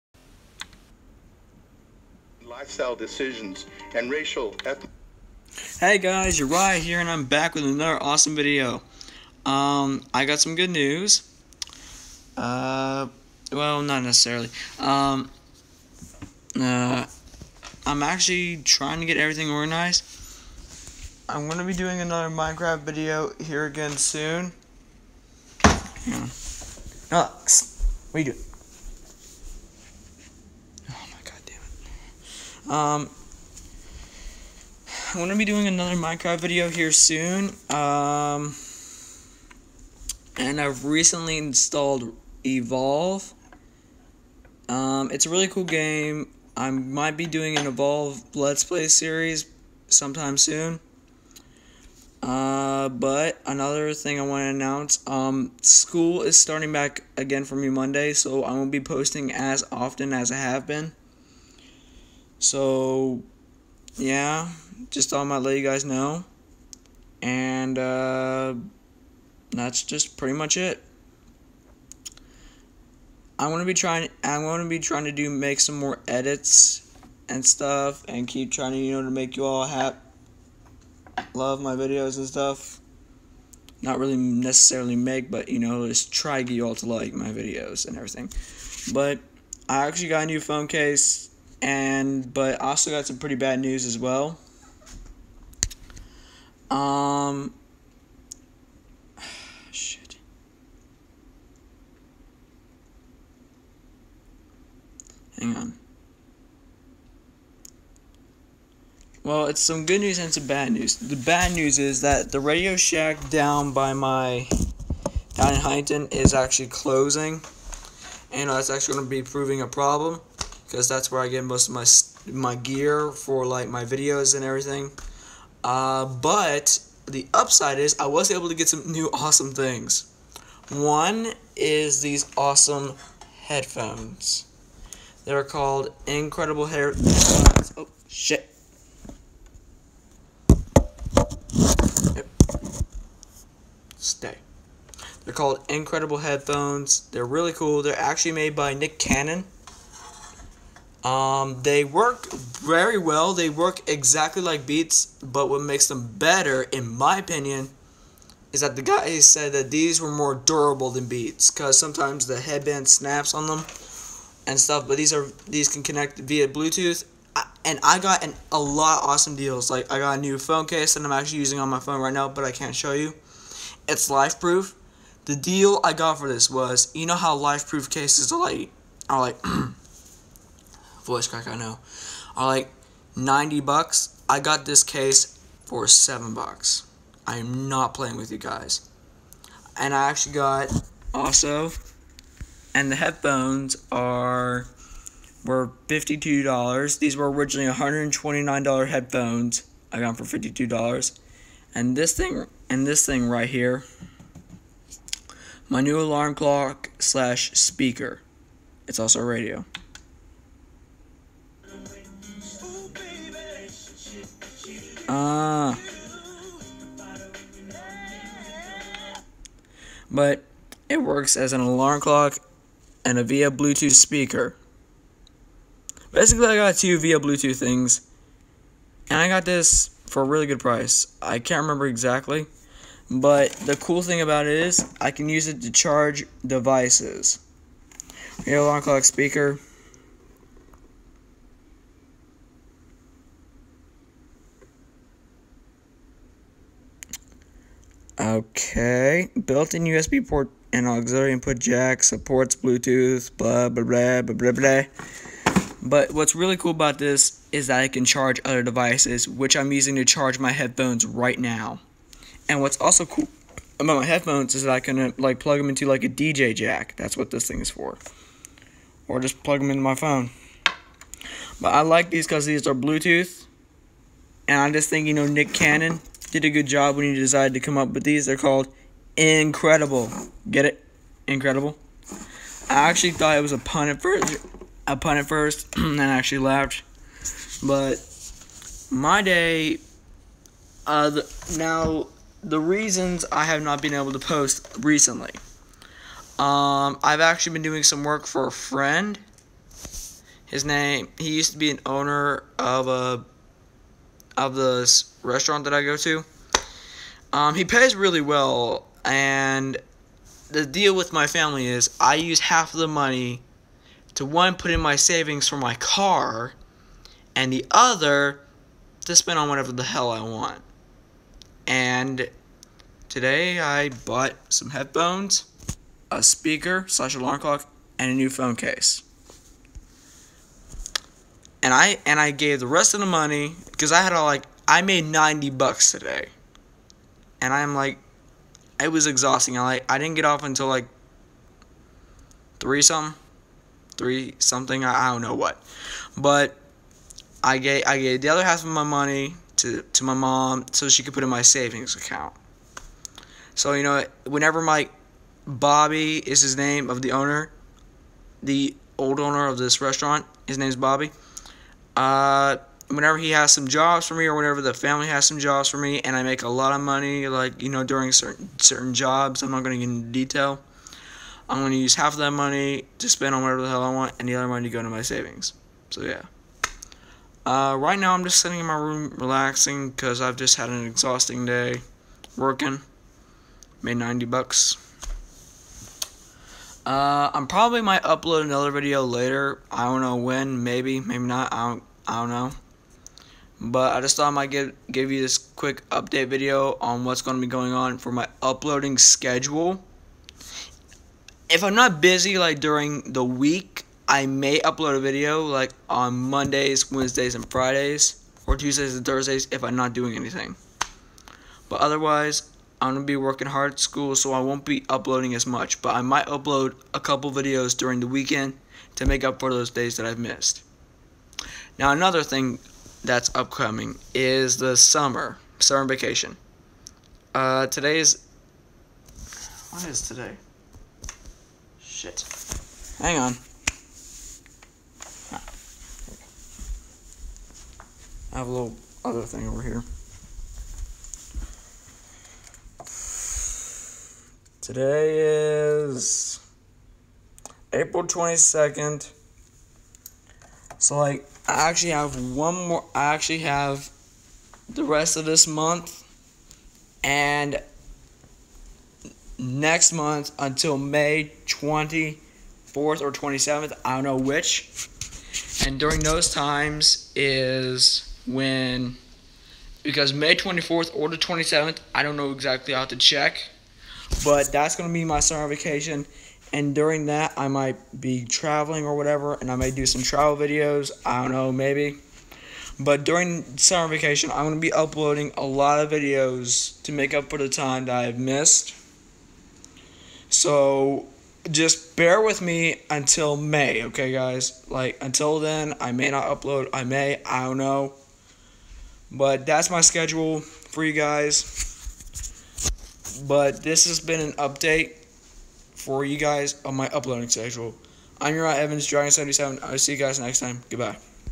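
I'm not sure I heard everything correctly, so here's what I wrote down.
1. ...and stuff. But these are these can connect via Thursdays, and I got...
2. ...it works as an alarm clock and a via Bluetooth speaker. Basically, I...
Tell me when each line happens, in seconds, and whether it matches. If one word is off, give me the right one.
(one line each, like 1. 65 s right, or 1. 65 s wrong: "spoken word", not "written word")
1. 164 s wrong: "Bluetooth", not "Thursdays"
2. 220 s right.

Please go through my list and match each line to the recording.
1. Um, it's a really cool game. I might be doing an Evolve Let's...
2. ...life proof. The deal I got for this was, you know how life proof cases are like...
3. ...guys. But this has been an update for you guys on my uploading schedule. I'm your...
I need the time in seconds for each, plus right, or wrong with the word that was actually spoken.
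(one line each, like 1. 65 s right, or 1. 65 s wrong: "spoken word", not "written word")
1. 44 s right
2. 174 s right
3. 500 s right.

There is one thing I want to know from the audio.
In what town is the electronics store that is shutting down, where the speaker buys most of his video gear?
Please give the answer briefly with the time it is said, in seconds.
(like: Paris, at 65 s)
Huntington, at 115 s.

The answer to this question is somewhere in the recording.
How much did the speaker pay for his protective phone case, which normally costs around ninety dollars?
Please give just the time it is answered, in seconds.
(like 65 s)
185 s.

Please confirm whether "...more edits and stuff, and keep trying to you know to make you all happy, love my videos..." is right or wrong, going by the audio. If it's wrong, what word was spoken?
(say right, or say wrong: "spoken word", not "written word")
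right.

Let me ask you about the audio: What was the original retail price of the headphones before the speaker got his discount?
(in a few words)
$129.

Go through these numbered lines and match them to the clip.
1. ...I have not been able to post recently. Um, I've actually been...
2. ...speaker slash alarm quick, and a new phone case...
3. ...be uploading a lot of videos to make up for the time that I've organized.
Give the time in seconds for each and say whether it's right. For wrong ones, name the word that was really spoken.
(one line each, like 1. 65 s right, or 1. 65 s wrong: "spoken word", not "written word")
1. 293 s right
2. 326 s wrong: "clock", not "quick"
3. 484 s wrong: "missed", not "organized".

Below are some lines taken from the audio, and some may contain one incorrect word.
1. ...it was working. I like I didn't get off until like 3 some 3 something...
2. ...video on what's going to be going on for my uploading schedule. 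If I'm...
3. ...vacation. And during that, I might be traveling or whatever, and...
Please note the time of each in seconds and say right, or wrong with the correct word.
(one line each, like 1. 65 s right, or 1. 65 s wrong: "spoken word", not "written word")
1. 338 s wrong: "exhausting", not "working"
2. 396 s right
3. 475 s right.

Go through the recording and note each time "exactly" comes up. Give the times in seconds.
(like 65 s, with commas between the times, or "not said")
153 s, 231 s, 472 s.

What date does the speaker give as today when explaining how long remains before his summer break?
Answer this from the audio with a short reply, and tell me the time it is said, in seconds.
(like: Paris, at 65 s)
April 22nd, at 447 s.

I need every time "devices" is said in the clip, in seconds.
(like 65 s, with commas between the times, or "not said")
236 s, 258 s.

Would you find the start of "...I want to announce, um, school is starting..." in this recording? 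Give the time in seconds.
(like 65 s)
54 s.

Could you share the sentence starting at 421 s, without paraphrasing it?
Now, another thing that's upcoming is the summer, summer vacation.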